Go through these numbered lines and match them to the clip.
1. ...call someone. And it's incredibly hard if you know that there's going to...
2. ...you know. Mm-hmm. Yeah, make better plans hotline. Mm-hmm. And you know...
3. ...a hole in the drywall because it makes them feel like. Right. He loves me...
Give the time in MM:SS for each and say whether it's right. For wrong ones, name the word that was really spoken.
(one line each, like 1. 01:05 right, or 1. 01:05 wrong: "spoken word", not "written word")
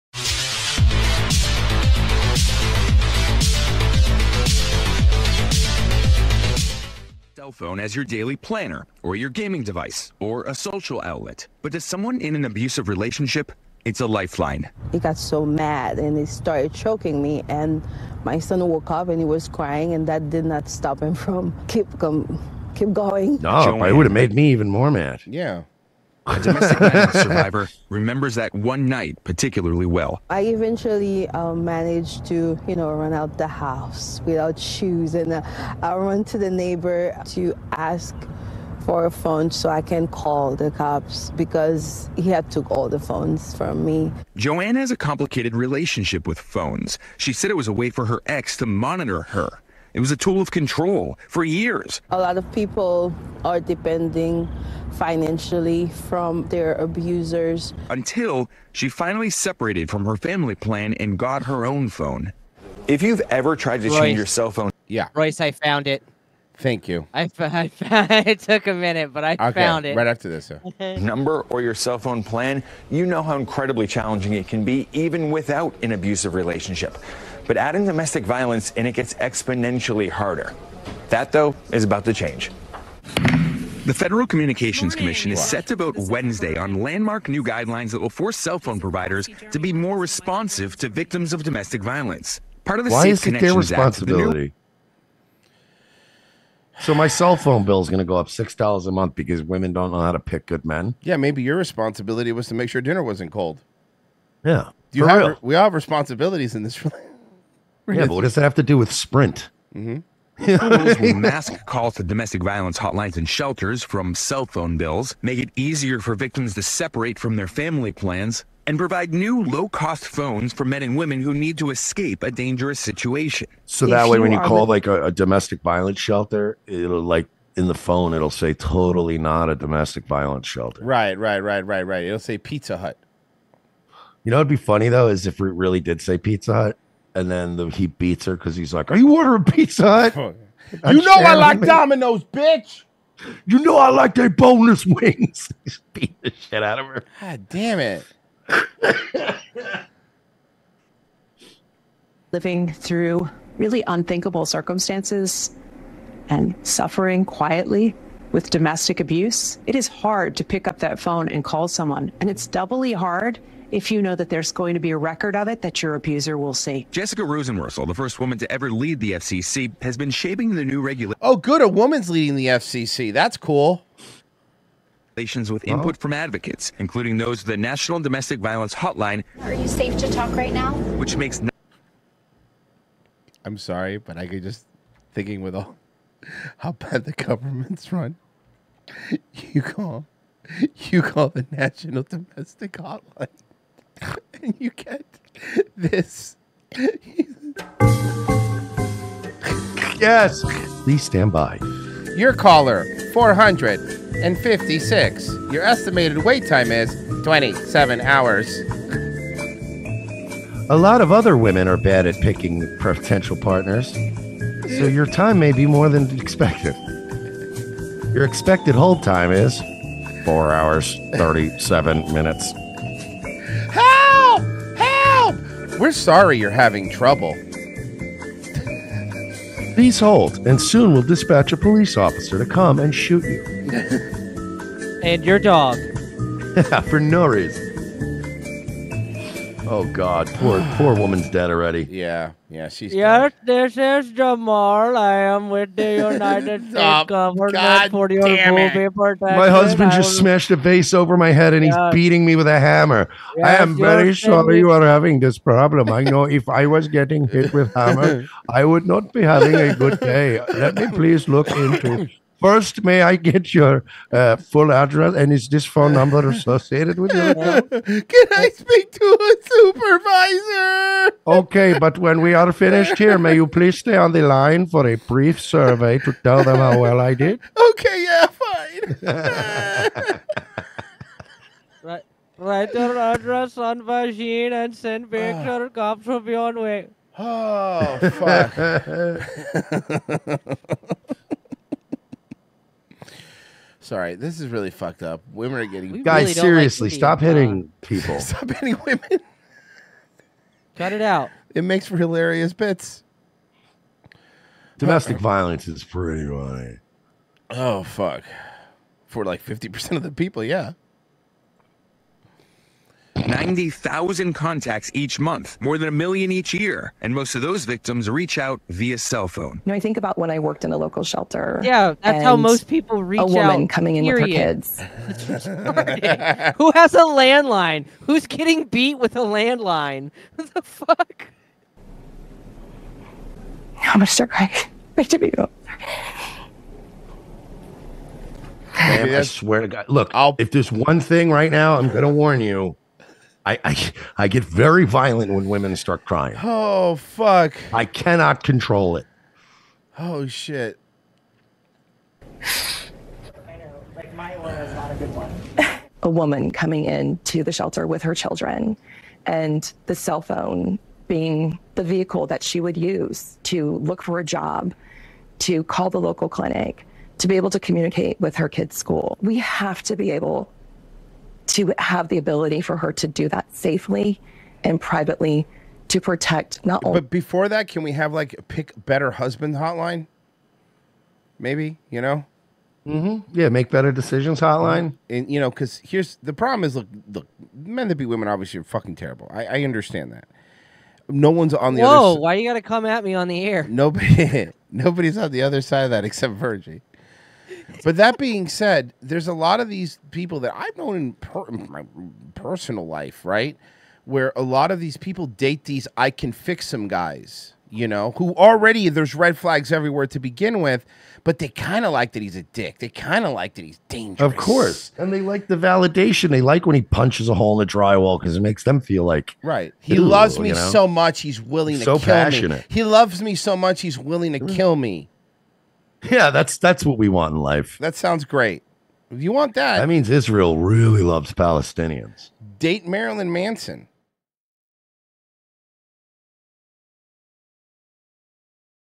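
1. 02:41 wrong: "doubly", not "incredibly"
2. 06:21 wrong: "decisions", not "plans"
3. 06:57 right.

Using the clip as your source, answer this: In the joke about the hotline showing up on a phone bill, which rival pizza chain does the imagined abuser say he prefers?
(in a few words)
Domino's.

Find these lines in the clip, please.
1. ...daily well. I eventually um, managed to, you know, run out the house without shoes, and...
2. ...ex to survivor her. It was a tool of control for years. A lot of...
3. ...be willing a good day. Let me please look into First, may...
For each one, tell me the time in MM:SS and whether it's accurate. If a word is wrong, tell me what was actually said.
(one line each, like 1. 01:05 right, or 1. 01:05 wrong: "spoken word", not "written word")
1. 00:29 wrong: "particularly", not "daily"
2. 00:48 wrong: "monitor", not "survivor"
3. 04:19 wrong: "having", not "willing".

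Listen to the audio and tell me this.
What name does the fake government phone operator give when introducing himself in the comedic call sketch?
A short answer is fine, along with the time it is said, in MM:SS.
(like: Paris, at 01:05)
Jamal, at 04:04.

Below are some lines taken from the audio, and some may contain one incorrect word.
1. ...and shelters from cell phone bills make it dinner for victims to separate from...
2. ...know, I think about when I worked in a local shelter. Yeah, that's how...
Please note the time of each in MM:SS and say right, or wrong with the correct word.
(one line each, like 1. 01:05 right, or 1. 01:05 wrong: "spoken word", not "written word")
1. 01:53 wrong: "easier", not "dinner"
2. 05:19 right.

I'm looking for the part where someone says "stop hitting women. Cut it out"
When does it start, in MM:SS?
04:58.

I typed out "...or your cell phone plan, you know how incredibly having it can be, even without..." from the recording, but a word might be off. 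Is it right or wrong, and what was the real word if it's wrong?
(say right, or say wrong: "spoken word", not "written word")
wrong: "challenging", not "having".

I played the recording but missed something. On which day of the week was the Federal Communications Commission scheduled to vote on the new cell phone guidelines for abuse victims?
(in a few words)
Wednesday.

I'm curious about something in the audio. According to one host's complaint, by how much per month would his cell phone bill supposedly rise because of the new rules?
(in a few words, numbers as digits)
$6.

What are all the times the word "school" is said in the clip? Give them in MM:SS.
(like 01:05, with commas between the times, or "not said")
06:08.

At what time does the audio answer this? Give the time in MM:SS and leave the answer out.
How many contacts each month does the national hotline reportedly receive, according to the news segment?
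05:13.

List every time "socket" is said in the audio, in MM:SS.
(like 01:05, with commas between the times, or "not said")
not said.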